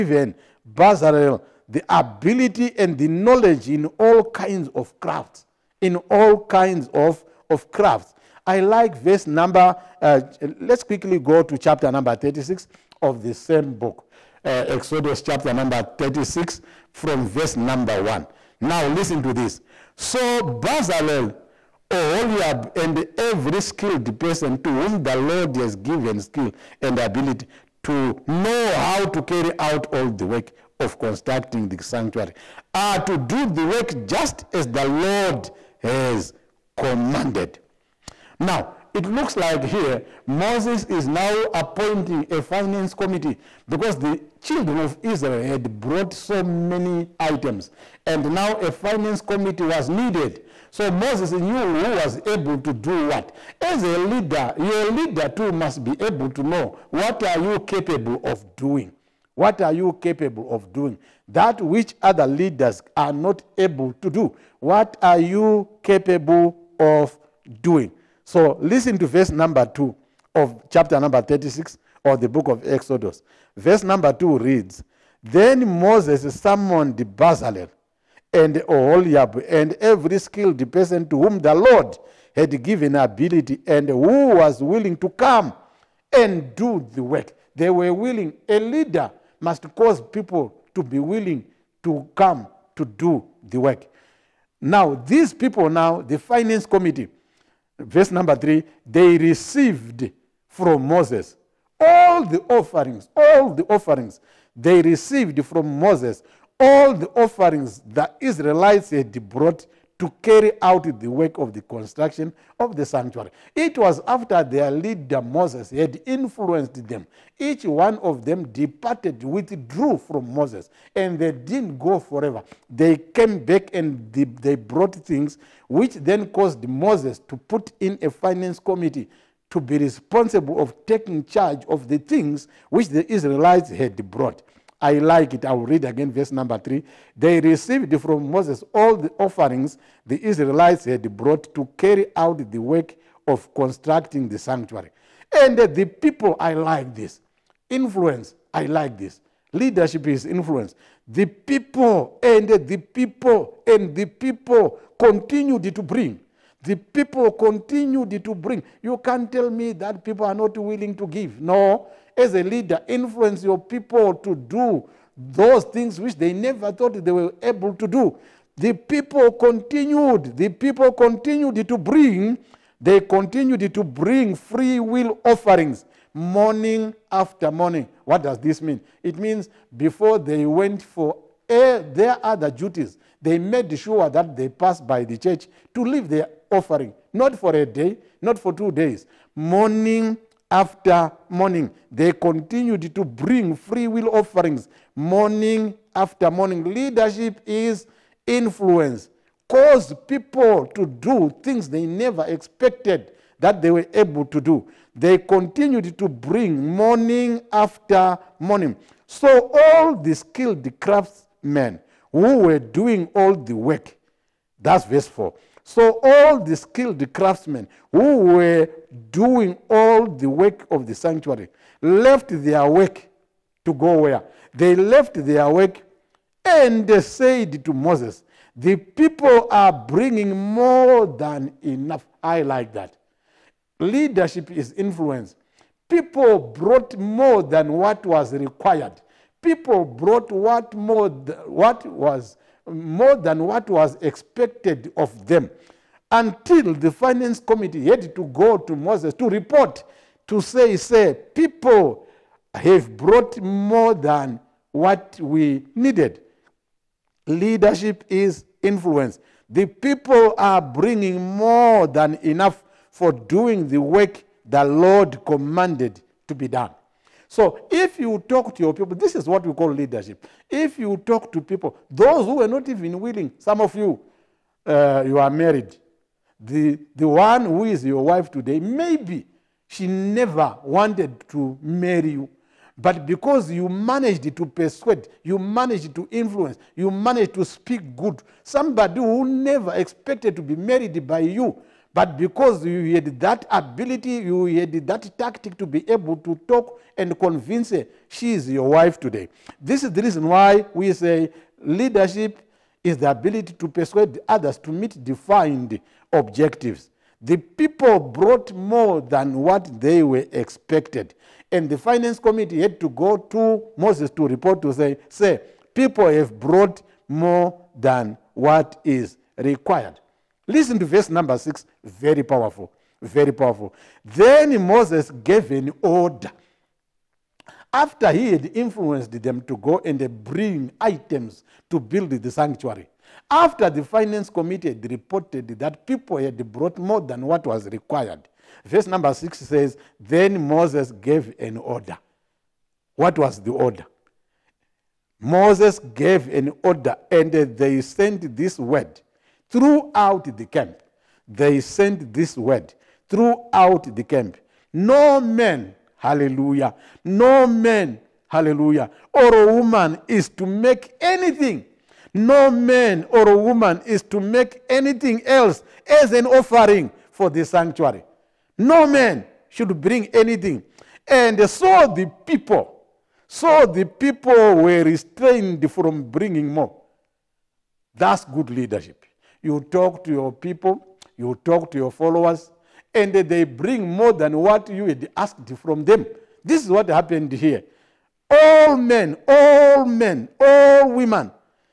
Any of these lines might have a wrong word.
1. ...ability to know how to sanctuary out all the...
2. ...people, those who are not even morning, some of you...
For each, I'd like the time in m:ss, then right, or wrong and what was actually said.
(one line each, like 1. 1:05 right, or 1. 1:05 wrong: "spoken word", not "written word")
1. 0:26 wrong: "carry", not "sanctuary"
2. 4:31 wrong: "willing", not "morning".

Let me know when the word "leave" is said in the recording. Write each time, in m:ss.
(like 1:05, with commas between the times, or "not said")
3:05.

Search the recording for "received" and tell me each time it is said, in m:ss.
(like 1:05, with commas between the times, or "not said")
1:39, 1:44, 2:17.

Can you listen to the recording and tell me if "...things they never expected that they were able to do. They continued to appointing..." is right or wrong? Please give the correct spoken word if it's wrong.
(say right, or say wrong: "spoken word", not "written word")
wrong: "bring", not "appointing".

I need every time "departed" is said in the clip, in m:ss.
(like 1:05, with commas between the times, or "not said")
1:58.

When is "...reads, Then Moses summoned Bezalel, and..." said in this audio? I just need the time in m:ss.
1:14.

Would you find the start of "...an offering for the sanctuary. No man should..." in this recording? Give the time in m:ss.
6:06.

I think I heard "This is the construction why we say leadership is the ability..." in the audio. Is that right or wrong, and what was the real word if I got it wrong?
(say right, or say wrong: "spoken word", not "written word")
wrong: "reason", not "construction".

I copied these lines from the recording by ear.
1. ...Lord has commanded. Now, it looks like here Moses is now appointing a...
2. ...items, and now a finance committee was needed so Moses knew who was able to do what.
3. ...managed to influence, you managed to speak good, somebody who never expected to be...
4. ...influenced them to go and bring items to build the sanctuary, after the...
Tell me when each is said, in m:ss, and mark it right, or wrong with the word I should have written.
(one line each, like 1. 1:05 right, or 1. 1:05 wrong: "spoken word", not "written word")
1. 0:34 right
2. 0:47 right
3. 4:45 right
4. 5:28 right.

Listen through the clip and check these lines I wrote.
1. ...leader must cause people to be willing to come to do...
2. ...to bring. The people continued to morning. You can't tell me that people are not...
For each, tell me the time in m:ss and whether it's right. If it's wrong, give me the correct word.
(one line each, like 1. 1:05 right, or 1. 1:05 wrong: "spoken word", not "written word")
1. 1:28 right
2. 2:35 wrong: "bring", not "morning".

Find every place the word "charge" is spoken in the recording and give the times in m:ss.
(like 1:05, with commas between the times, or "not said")
2:11.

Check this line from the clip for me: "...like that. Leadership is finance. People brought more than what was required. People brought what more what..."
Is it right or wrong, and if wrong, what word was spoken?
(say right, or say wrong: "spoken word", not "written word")
wrong: "influence", not "finance".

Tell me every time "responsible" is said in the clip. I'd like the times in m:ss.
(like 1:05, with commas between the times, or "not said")
2:09.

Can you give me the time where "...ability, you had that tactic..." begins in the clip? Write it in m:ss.
4:53.